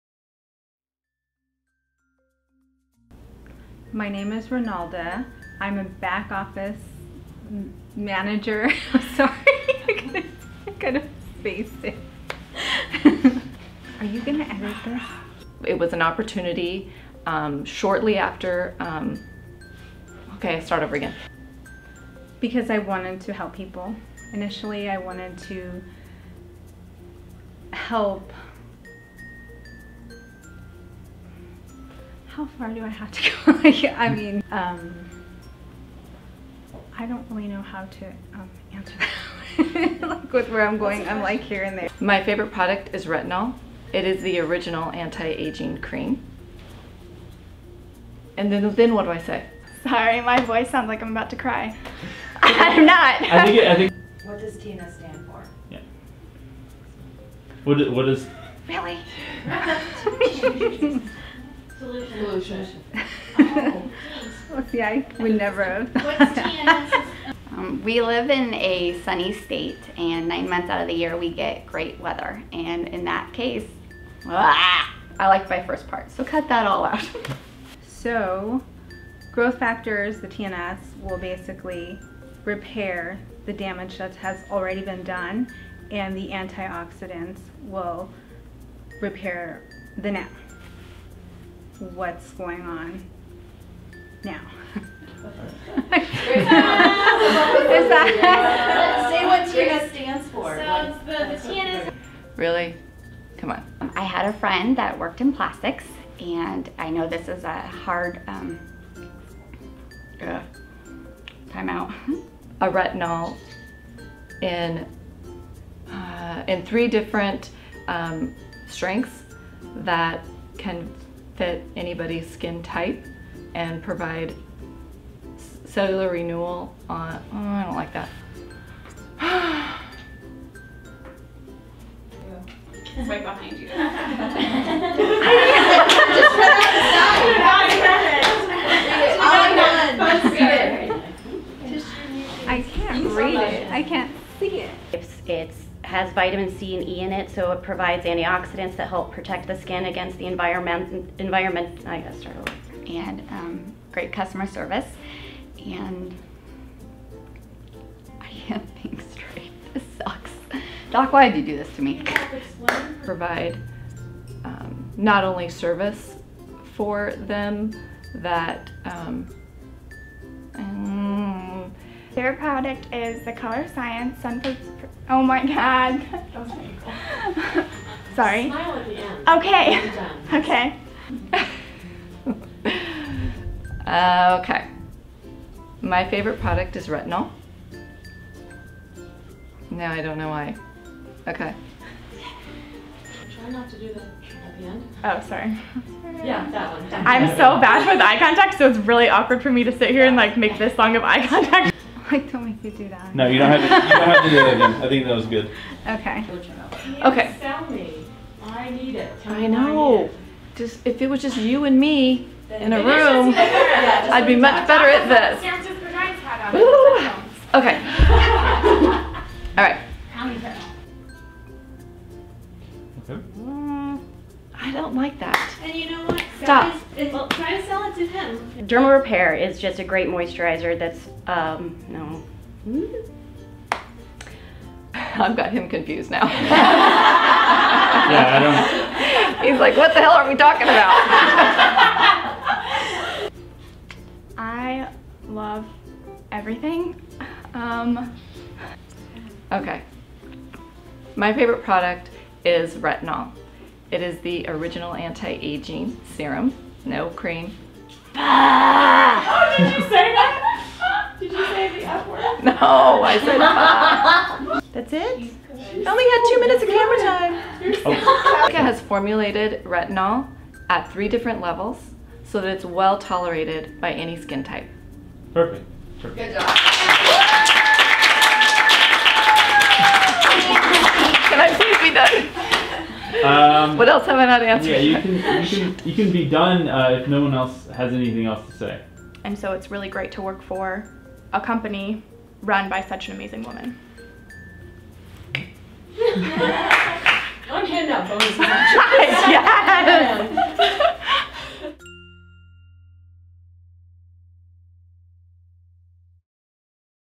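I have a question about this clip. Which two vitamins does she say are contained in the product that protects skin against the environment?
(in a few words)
Vitamin C and E.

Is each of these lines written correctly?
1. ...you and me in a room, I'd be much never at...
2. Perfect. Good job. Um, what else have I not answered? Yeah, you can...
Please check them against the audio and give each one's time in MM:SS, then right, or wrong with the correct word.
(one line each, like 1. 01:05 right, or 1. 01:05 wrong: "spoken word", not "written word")
1. 03:31 wrong: "better", not "never"
2. 04:36 right.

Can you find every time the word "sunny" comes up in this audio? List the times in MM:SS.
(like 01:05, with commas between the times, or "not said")
01:09.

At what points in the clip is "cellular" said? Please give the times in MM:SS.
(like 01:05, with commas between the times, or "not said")
02:05.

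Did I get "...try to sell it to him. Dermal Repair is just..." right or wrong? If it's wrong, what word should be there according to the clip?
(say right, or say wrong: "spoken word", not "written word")
right.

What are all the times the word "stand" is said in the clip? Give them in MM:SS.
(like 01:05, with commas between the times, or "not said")
00:54, 01:39.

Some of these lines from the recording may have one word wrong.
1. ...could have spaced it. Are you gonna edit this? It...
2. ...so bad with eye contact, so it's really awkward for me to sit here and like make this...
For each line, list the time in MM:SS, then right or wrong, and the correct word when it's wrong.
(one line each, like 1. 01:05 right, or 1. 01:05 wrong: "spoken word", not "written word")
1. 00:10 right
2. 03:17 right.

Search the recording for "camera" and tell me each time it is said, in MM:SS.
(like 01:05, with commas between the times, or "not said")
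04:26.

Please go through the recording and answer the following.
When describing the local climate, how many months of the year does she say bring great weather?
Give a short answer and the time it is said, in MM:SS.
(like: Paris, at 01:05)
9, at 01:10.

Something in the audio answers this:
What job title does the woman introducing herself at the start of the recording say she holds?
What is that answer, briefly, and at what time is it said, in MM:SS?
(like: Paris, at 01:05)
Back office manager, at 00:05.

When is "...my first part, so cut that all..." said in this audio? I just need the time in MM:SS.
01:15.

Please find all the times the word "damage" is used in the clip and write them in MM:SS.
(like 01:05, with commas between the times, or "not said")
01:23.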